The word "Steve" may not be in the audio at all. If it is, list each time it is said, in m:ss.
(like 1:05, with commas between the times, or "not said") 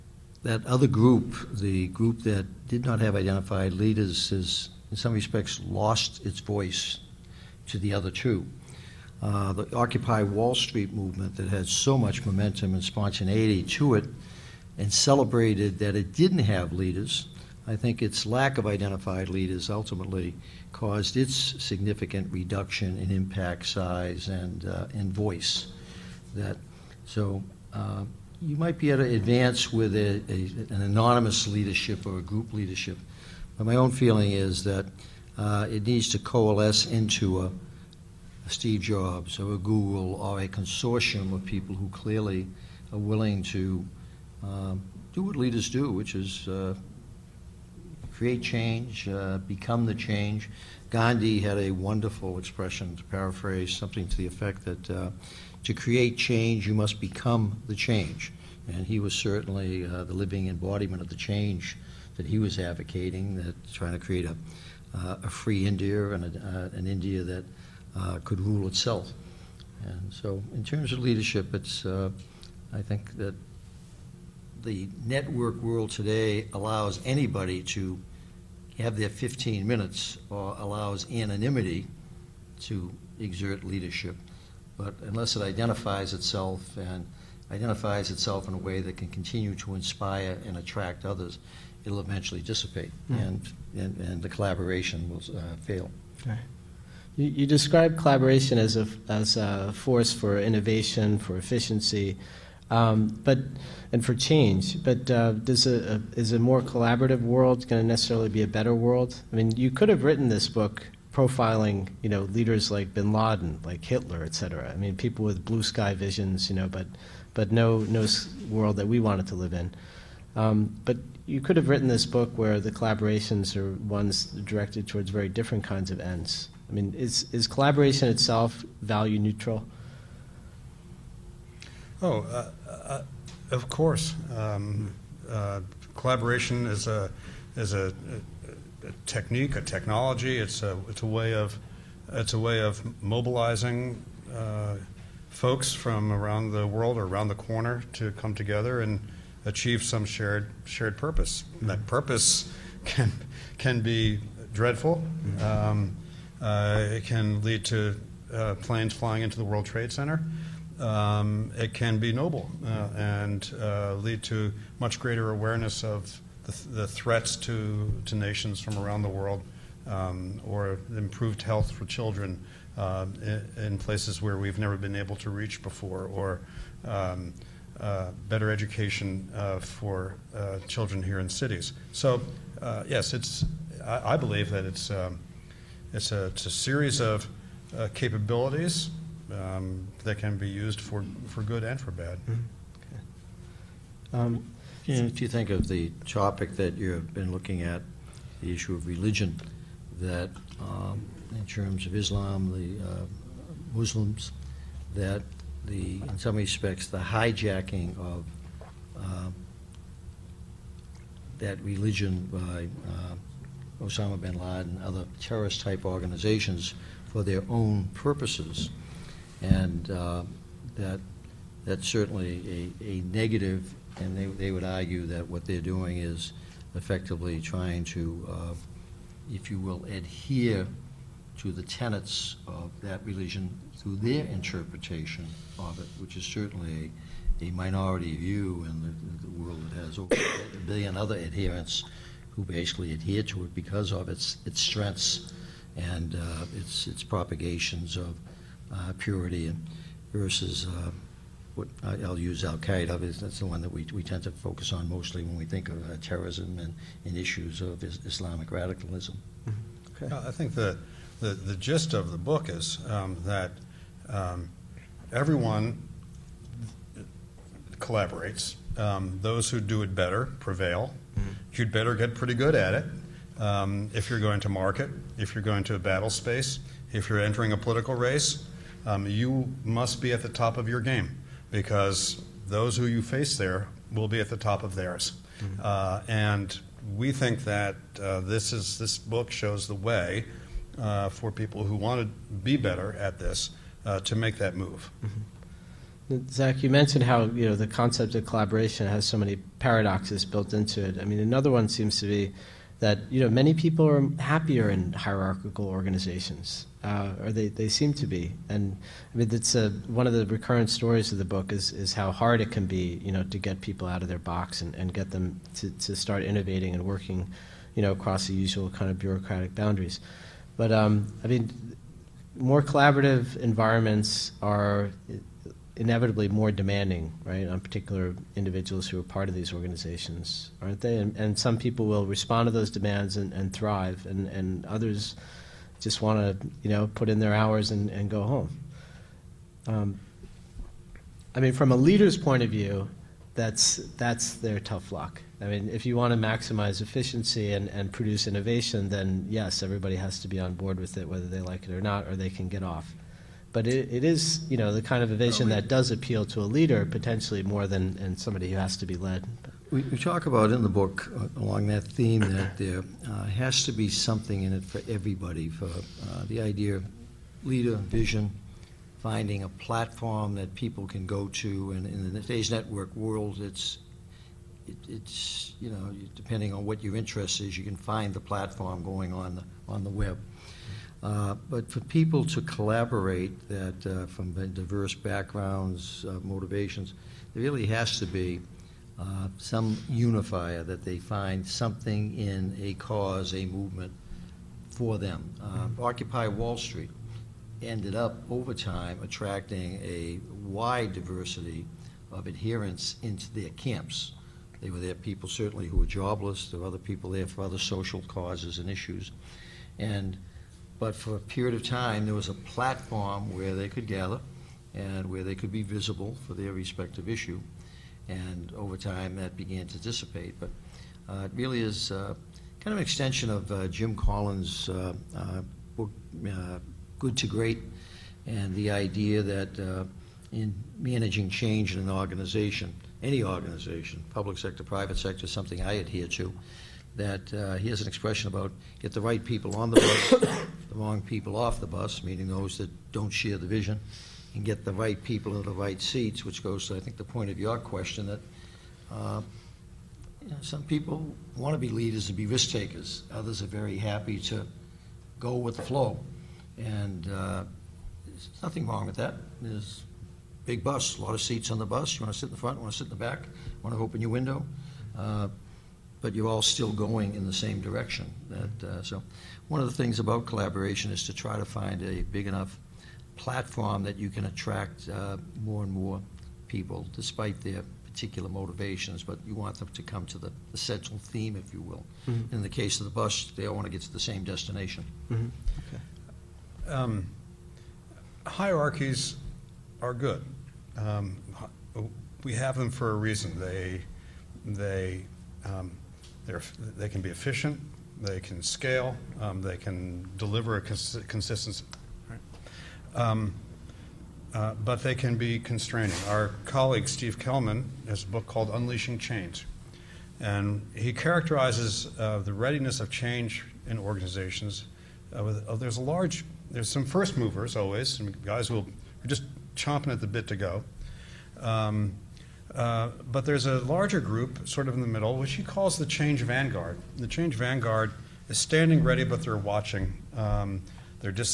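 0:38, 8:26.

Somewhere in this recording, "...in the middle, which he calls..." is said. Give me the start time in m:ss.
8:44.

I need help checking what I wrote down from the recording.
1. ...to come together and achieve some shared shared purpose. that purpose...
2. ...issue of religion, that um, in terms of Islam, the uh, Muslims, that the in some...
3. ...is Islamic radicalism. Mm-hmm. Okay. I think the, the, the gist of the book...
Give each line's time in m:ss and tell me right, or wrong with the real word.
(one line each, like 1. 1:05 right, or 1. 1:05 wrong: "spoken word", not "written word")
1. 2:27 right
2. 3:18 right
3. 4:17 right.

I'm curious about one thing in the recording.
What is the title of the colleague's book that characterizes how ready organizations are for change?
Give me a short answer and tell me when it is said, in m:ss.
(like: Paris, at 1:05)
Unleashing Change, at 8:28.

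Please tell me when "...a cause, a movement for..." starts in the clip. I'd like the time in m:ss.
6:32.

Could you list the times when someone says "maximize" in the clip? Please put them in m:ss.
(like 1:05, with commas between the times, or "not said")
5:46.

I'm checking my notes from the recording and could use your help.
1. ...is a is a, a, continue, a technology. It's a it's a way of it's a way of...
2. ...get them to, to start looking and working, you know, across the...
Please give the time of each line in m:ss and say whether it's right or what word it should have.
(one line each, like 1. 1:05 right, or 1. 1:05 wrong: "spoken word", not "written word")
1. 2:16 wrong: "technique", not "continue"
2. 5:14 wrong: "innovating", not "looking".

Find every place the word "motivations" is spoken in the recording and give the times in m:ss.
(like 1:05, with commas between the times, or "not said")
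6:26, 7:58.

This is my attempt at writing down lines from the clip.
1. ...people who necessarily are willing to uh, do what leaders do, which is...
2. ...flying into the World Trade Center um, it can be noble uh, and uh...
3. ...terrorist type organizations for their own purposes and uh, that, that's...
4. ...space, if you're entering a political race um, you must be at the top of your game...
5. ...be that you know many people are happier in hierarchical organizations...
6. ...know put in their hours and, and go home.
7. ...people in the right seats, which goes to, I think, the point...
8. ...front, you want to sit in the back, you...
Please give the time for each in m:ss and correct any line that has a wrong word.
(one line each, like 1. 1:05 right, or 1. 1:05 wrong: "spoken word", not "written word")
1. 0:41 wrong: "clearly", not "necessarily"
2. 2:38 right
3. 3:35 right
4. 4:36 right
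5. 5:02 right
6. 5:36 right
7. 7:25 right
8. 7:42 right.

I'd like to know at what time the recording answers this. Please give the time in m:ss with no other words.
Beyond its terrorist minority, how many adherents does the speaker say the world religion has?
3:59.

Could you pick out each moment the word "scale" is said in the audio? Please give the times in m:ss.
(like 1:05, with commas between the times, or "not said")
8:18.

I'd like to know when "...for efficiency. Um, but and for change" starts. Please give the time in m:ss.
1:41.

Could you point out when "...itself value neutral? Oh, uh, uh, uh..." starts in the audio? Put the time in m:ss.
2:08.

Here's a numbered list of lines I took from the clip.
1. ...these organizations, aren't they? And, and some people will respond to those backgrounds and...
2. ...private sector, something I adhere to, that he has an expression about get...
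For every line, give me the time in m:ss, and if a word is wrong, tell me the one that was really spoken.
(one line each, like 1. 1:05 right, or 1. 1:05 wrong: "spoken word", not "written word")
1. 5:29 wrong: "demands", not "backgrounds"
2. 7:14 right.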